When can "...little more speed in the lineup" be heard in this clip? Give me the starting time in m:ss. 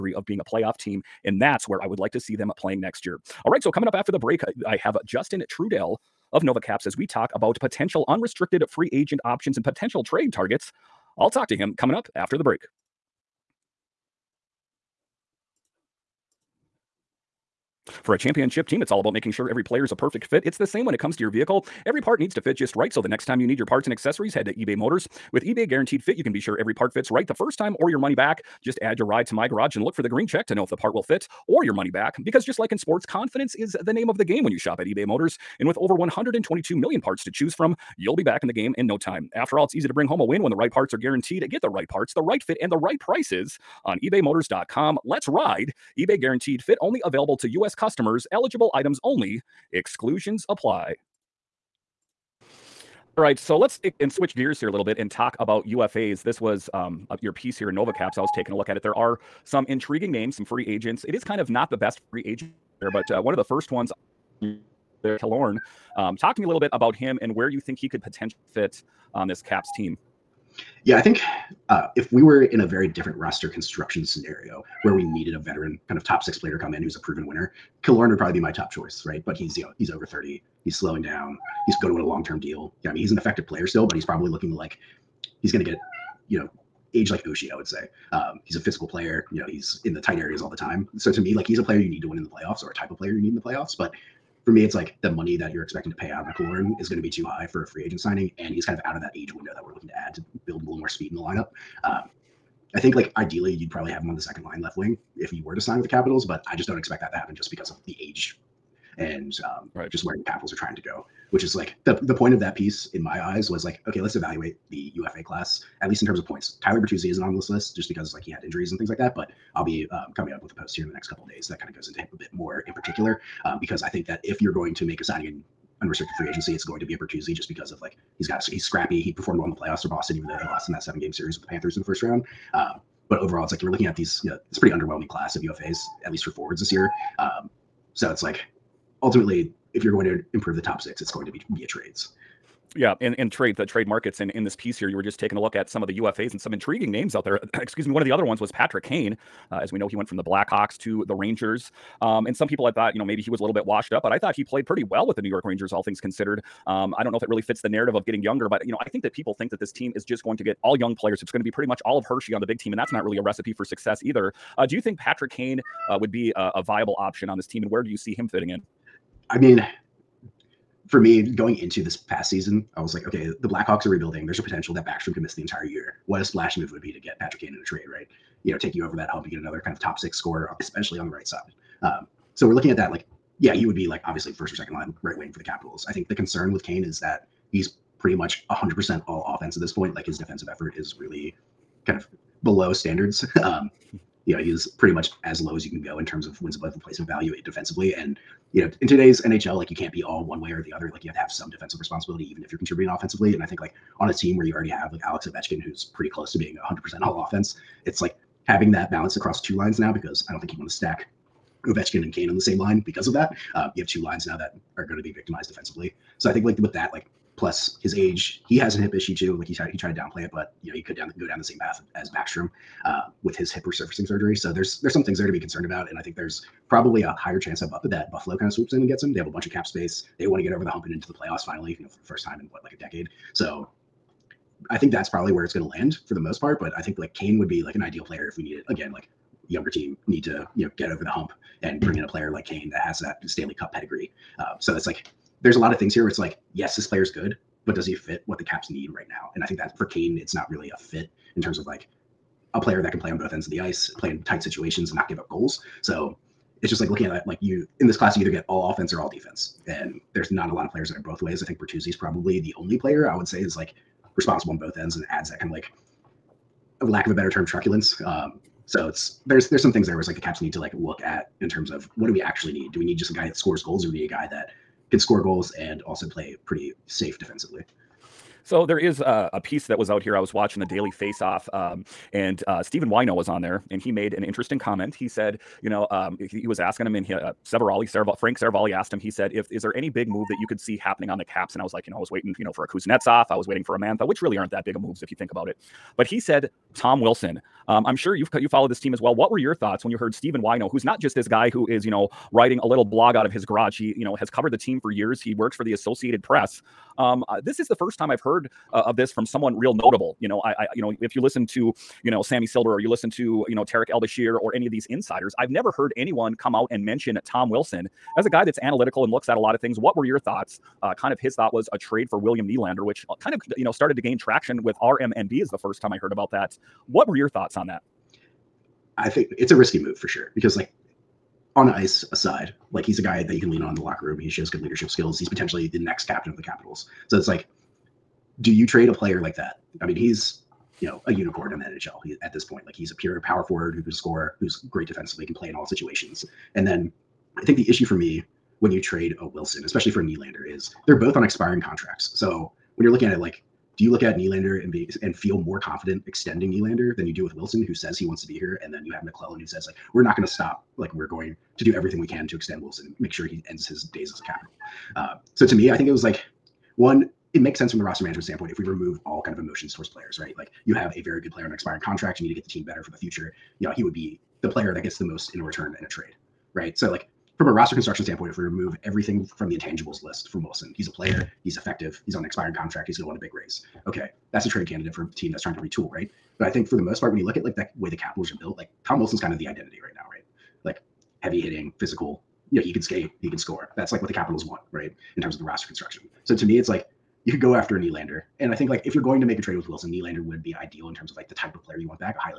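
1:40.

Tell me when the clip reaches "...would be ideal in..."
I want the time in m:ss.
6:40.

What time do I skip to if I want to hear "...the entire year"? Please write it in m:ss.
2:55.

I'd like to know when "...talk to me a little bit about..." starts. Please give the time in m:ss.
1:06.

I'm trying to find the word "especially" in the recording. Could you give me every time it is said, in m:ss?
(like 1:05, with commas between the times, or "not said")
3:00, 5:49.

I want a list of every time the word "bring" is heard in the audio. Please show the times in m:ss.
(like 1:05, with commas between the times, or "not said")
0:39, 4:01.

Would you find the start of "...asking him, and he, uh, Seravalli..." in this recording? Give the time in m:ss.
4:46.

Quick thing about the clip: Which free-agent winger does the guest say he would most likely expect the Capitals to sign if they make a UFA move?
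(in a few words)
Tyler Bertuzzi.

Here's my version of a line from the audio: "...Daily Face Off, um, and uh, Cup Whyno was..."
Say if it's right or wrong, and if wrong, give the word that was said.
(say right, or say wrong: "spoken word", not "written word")
wrong: "Stephen", not "Cup".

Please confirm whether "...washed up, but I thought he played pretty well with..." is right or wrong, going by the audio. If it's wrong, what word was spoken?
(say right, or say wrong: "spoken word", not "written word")
right.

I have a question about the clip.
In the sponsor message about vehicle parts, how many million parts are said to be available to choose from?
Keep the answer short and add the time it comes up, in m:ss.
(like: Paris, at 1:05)
122 million, at 0:35.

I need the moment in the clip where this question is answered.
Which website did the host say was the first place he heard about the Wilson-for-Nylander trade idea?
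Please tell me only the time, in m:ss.
5:24.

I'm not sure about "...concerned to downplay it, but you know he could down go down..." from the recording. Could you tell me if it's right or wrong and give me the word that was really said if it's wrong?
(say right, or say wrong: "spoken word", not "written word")
wrong: "tried", not "concerned".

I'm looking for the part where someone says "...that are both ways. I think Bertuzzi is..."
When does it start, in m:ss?
4:20.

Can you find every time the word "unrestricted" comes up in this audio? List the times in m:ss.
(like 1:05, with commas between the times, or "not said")
0:08, 2:05.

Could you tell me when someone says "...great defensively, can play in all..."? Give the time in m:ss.
5:44.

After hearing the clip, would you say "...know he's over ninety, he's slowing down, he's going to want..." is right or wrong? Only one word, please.
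wrong.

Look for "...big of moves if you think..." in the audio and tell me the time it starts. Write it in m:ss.
4:54.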